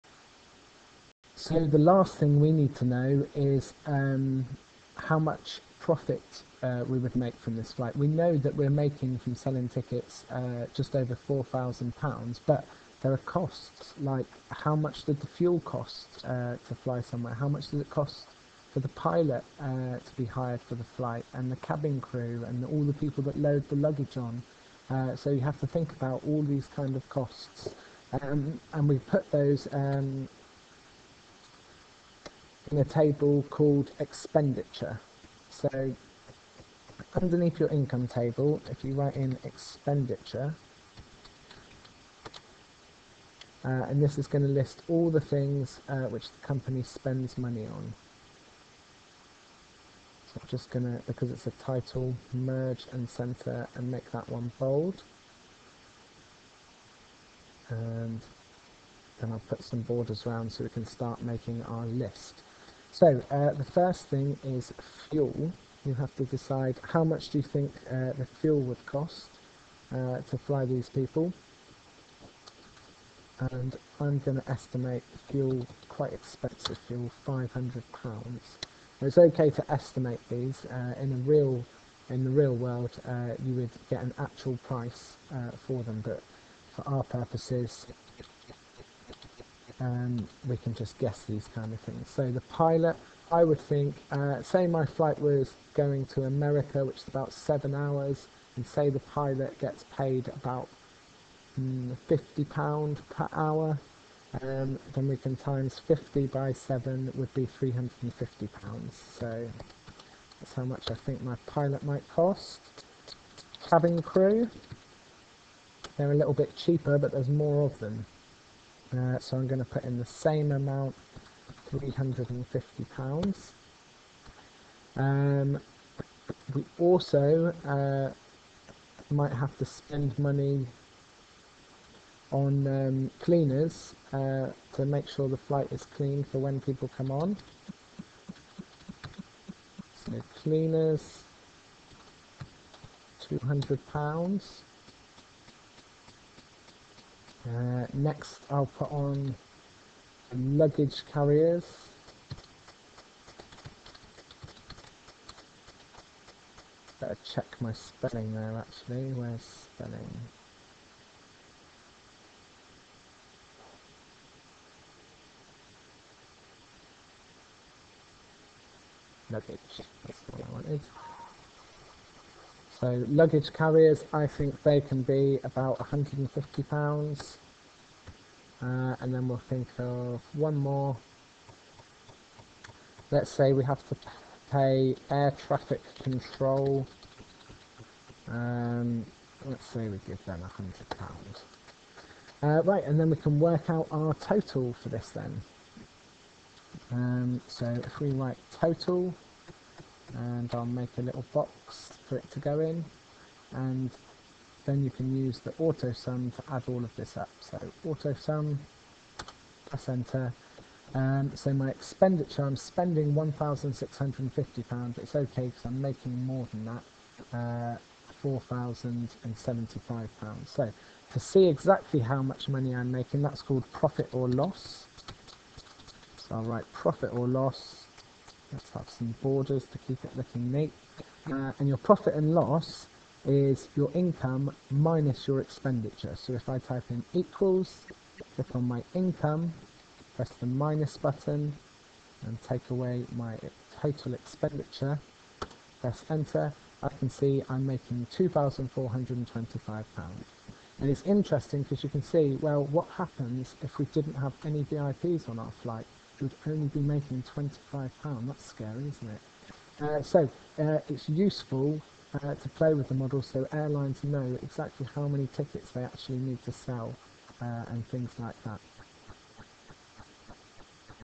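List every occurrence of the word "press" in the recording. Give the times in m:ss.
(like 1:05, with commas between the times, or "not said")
3:29, 4:00, 4:05.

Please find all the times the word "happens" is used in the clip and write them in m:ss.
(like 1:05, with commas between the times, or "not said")
4:12.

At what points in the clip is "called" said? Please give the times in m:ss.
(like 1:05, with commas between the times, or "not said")
0:33, 3:43.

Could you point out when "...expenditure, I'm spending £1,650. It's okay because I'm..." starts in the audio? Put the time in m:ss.
3:31.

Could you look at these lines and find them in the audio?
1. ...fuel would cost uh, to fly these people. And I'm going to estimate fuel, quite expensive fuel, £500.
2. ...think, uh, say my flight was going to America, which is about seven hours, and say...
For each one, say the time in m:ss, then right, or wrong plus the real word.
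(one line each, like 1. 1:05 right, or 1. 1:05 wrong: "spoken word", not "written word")
1. 1:08 right
2. 1:33 right.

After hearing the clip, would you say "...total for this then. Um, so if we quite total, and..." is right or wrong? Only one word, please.
wrong.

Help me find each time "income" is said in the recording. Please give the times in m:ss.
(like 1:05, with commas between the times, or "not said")
0:37, 3:53, 3:58.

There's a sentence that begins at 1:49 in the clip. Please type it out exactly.
So that's how much I think my pilot might cost.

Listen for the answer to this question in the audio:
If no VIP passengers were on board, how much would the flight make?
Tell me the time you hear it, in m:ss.
4:17.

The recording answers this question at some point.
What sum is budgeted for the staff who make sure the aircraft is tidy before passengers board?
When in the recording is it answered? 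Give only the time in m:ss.
2:23.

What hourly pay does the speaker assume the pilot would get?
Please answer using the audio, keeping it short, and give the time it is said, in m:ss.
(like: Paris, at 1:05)
£50, at 1:42.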